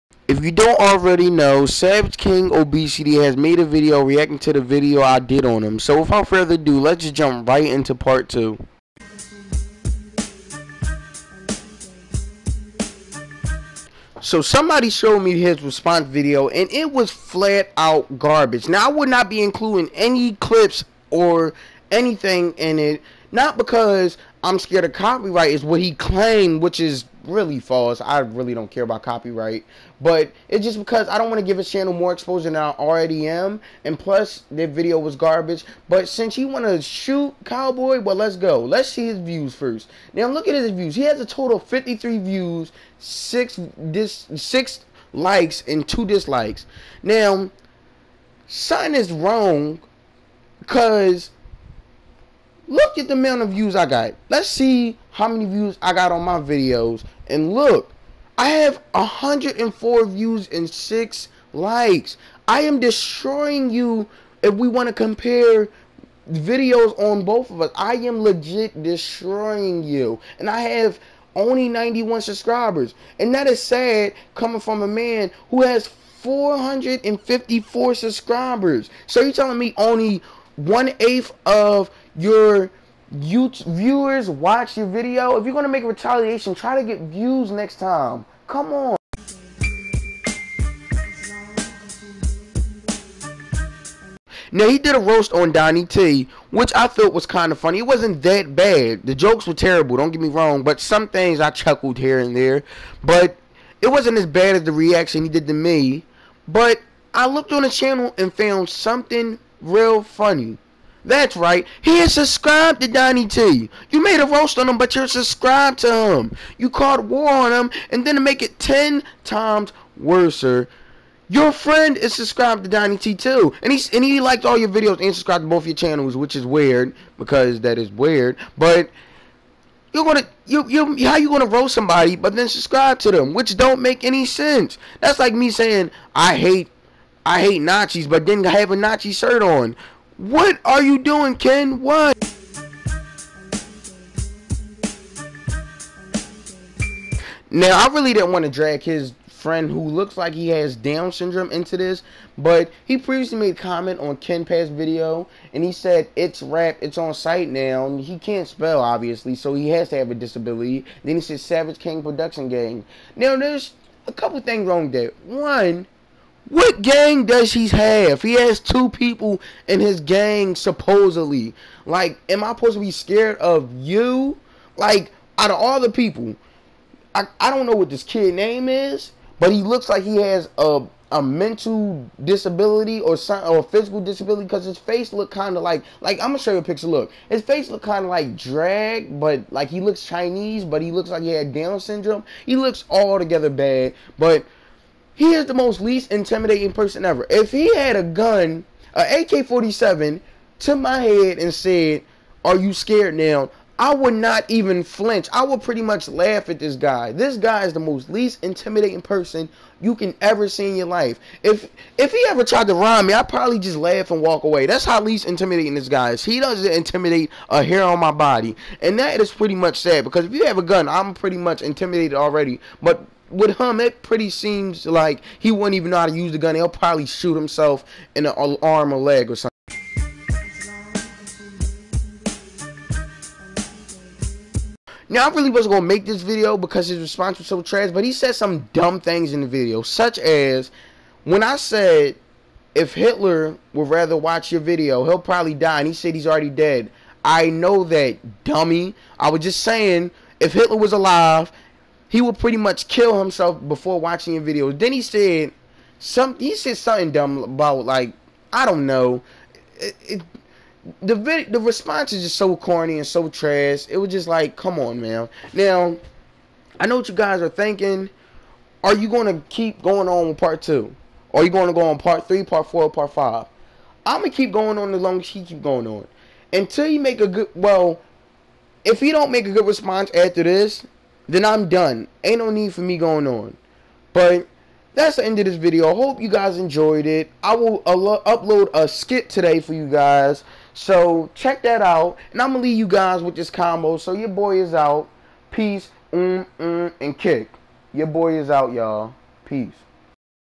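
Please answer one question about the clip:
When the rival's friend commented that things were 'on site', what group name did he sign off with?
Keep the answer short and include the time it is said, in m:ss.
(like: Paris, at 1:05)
Savage King Production Gang, at 2:41.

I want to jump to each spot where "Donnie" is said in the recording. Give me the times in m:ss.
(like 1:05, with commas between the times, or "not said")
1:35, 1:52, 2:02.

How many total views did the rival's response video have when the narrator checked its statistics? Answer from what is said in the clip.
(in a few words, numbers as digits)
53.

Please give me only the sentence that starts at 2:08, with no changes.
But you're gonna you you how you gonna roast somebody but then subscribe to them, which don't make any sense.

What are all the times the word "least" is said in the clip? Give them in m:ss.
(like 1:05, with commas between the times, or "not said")
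3:15, 3:28, 3:35.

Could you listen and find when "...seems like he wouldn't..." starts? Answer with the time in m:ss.
3:44.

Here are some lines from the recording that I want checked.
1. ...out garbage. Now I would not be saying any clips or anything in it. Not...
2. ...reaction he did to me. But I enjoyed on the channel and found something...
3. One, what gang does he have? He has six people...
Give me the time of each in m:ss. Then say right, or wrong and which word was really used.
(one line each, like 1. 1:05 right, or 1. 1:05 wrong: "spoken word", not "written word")
1. 0:17 wrong: "including", not "saying"
2. 1:44 wrong: "looked", not "enjoyed"
3. 2:45 wrong: "two", not "six".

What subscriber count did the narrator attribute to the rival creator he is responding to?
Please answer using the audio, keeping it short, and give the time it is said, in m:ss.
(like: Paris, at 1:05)
454, at 1:15.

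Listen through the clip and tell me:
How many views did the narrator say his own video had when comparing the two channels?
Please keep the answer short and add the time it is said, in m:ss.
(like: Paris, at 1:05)
104, at 0:58.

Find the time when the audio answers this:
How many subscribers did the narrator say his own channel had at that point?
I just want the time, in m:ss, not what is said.
1:11.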